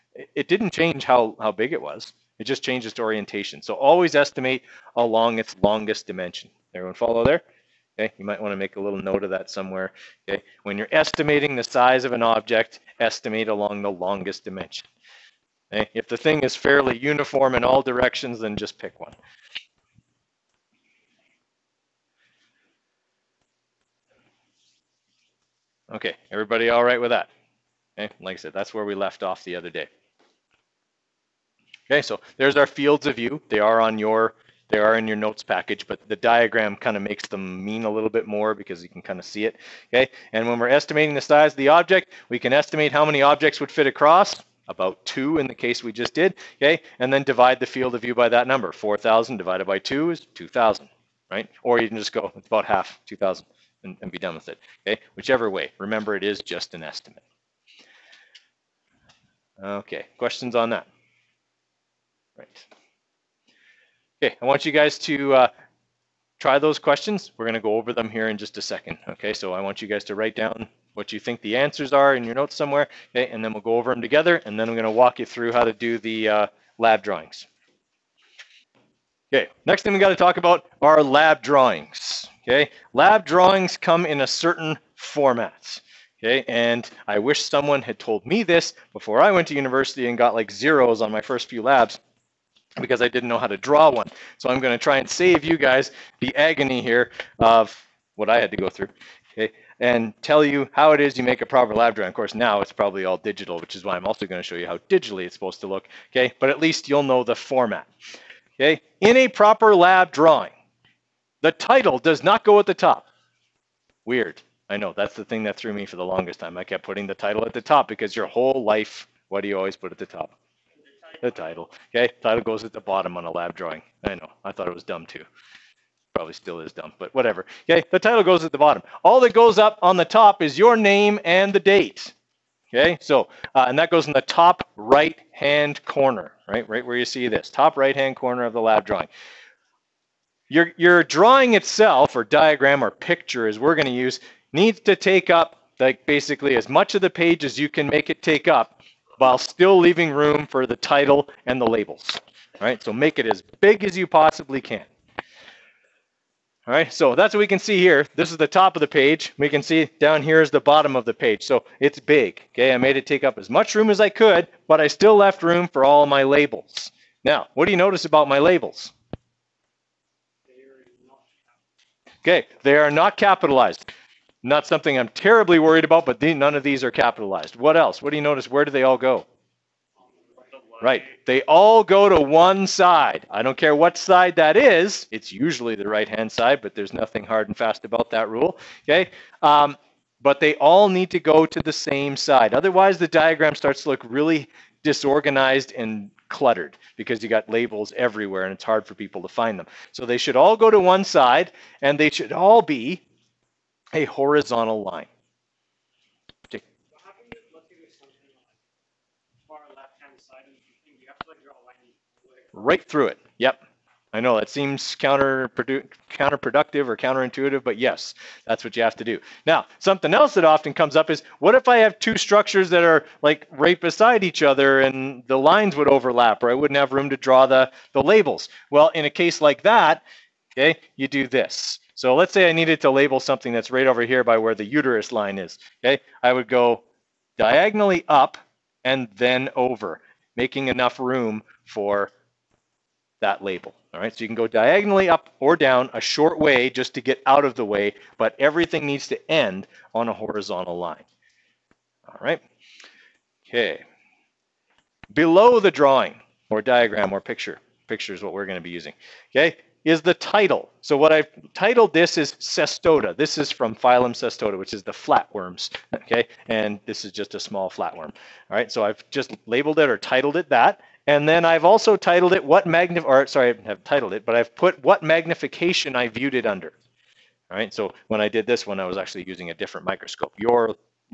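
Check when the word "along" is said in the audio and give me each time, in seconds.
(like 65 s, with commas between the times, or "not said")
4 s, 13 s.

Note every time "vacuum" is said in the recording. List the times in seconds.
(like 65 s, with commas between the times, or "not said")
not said.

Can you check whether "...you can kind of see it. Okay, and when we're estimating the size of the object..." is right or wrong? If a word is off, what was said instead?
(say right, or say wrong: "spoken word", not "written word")
right.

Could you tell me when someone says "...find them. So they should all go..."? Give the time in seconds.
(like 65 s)
199 s.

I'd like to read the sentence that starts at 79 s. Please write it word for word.
Okay, next thing we got to talk about are lab drawings.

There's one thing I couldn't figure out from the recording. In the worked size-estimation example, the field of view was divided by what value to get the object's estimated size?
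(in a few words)
2.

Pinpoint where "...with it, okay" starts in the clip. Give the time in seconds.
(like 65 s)
54 s.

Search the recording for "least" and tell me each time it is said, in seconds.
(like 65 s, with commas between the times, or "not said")
106 s.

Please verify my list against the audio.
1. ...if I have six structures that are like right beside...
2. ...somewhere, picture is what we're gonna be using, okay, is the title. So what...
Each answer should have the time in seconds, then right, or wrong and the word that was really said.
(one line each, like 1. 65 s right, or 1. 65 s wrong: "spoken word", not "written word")
1. 221 s wrong: "two", not "six"
2. 257 s wrong: "picture", not "somewhere".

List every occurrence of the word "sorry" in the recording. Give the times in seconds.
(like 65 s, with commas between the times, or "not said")
273 s.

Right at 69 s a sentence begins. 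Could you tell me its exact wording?
Okay, so I want you guys to write down what you think the answers are in your notes somewhere, okay?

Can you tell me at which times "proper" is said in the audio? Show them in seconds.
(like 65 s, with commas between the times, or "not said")
101 s, 109 s.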